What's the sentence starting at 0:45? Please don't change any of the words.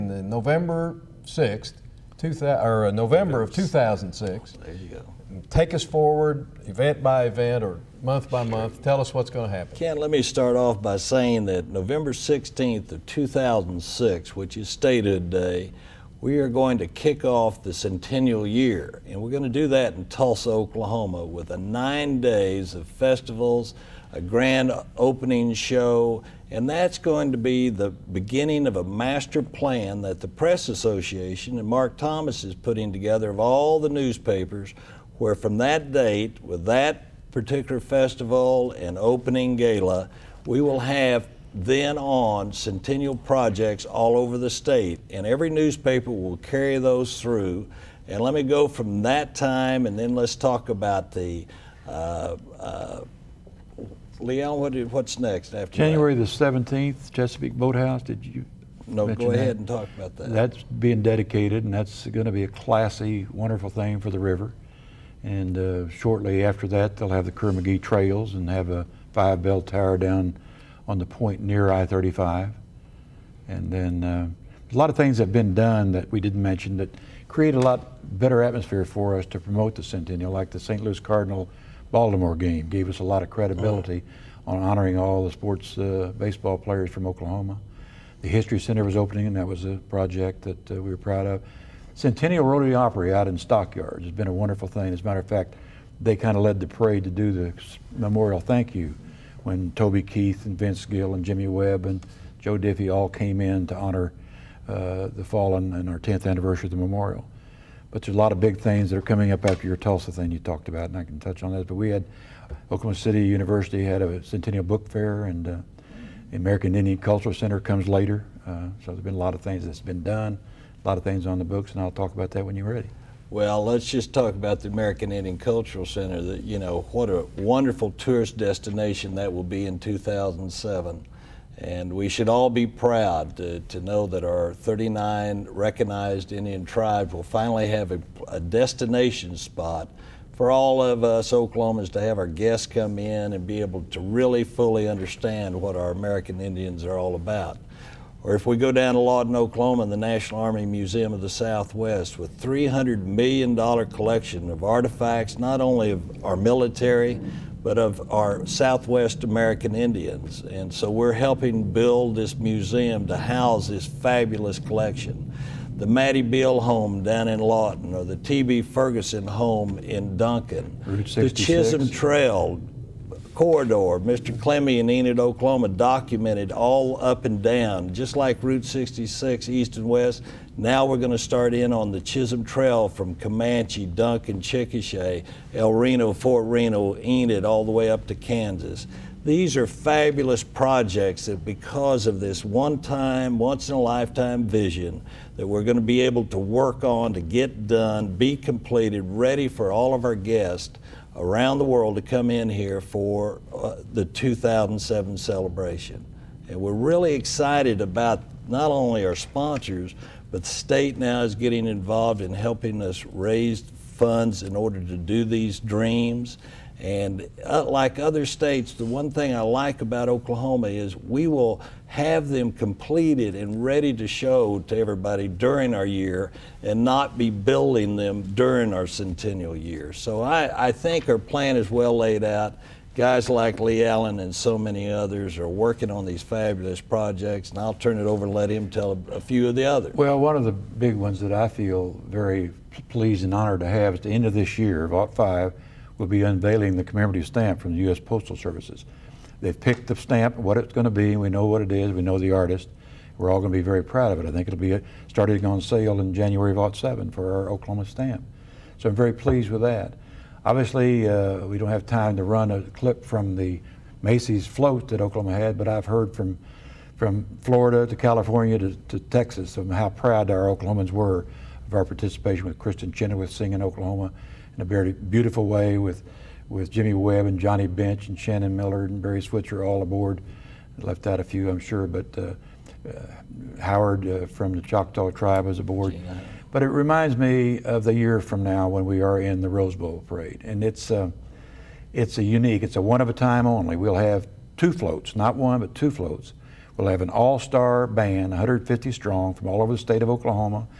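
And every newspaper will carry those through.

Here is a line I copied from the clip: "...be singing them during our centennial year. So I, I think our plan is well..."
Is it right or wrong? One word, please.
wrong.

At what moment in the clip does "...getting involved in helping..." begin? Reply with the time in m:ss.
3:31.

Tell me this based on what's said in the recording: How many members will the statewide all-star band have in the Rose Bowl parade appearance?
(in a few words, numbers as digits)
150.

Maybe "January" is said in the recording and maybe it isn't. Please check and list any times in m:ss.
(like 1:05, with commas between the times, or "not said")
0:55, 4:16.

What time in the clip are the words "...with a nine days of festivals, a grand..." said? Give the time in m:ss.
0:21.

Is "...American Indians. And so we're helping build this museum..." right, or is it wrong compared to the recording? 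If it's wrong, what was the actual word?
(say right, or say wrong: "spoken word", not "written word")
right.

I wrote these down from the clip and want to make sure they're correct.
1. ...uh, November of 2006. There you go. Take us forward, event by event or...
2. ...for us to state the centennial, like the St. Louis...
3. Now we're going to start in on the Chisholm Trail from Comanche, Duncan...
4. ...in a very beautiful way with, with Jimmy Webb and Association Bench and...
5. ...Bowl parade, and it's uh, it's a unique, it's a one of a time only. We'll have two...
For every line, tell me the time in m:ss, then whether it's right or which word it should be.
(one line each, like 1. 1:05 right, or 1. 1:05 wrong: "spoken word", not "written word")
1. 0:02 right
2. 1:18 wrong: "promote", not "state"
3. 3:00 right
4. 4:34 wrong: "Johnny", not "Association"
5. 4:49 right.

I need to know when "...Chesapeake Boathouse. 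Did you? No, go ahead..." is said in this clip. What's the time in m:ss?
0:57.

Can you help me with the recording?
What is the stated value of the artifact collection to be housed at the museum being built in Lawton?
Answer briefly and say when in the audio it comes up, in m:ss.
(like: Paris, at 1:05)
$300 million, at 2:32.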